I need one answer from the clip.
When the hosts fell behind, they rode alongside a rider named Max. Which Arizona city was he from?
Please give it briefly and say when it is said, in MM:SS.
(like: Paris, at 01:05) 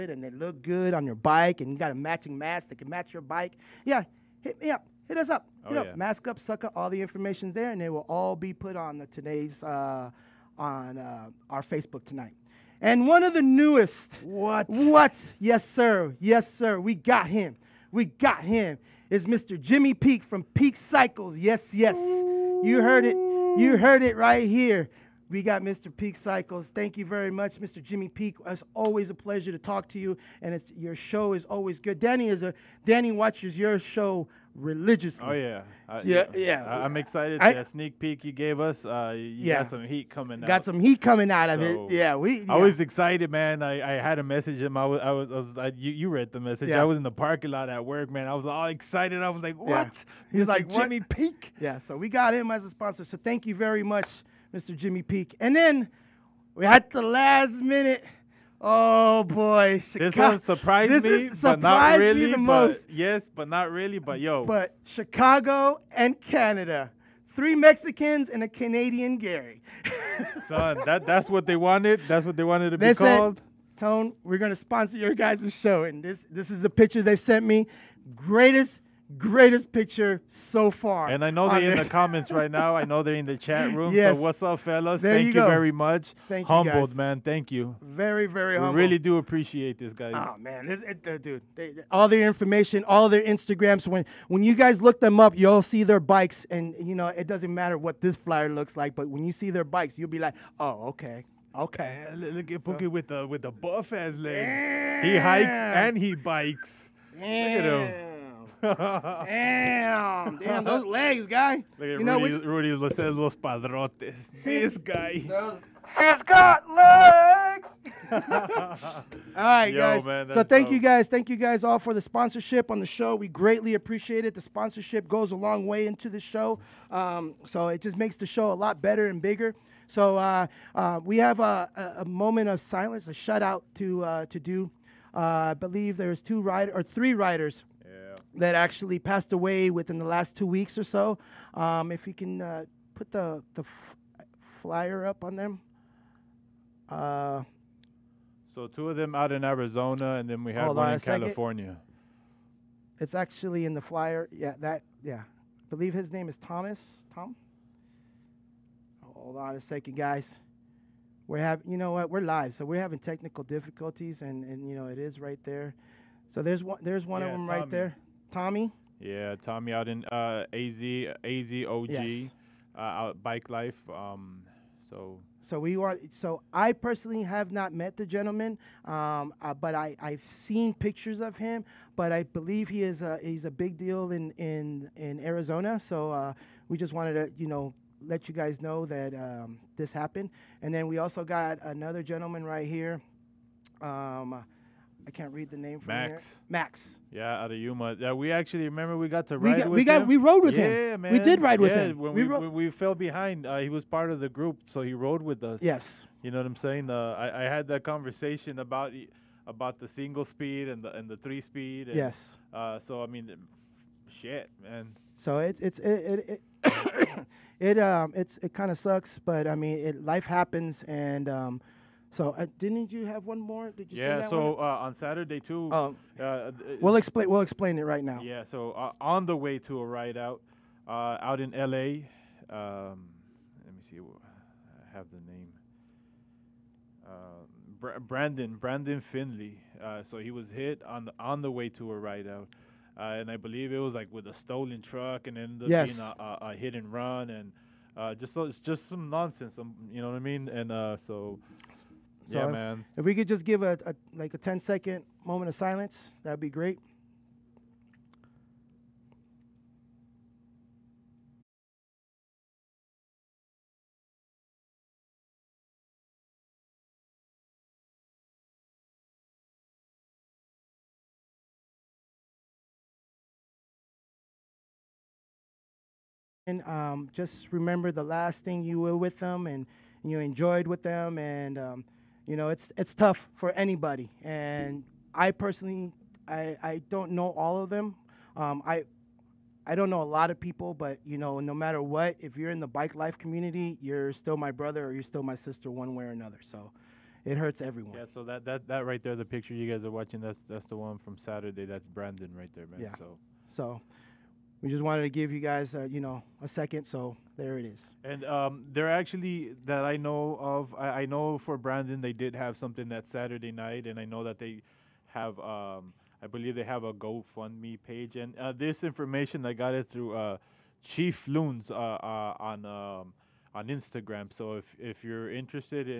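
Yuma, at 03:17.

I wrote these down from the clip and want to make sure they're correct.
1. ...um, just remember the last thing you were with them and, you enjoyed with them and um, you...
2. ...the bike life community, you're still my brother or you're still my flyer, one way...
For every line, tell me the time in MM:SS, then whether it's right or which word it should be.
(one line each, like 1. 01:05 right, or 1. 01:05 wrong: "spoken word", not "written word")
1. 04:36 right
2. 04:52 wrong: "sister", not "flyer".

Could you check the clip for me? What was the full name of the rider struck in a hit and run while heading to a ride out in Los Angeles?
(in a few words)
Brandon Finley.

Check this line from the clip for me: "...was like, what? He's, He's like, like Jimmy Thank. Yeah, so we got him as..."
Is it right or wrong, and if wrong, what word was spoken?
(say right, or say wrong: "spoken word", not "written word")
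wrong: "Peak", not "Thank".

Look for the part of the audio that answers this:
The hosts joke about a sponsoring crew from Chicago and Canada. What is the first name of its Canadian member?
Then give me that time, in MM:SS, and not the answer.
01:09.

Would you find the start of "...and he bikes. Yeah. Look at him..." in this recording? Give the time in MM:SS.
01:45.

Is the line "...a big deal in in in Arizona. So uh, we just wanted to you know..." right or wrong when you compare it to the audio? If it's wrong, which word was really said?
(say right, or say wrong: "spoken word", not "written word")
right.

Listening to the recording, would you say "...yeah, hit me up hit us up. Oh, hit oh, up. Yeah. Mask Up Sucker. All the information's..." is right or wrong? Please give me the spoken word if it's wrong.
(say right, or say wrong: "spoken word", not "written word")
right.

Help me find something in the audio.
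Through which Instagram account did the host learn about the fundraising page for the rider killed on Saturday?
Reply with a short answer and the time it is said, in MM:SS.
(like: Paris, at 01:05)
Chief Loons, at 05:20.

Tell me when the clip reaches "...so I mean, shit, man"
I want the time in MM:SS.
03:32.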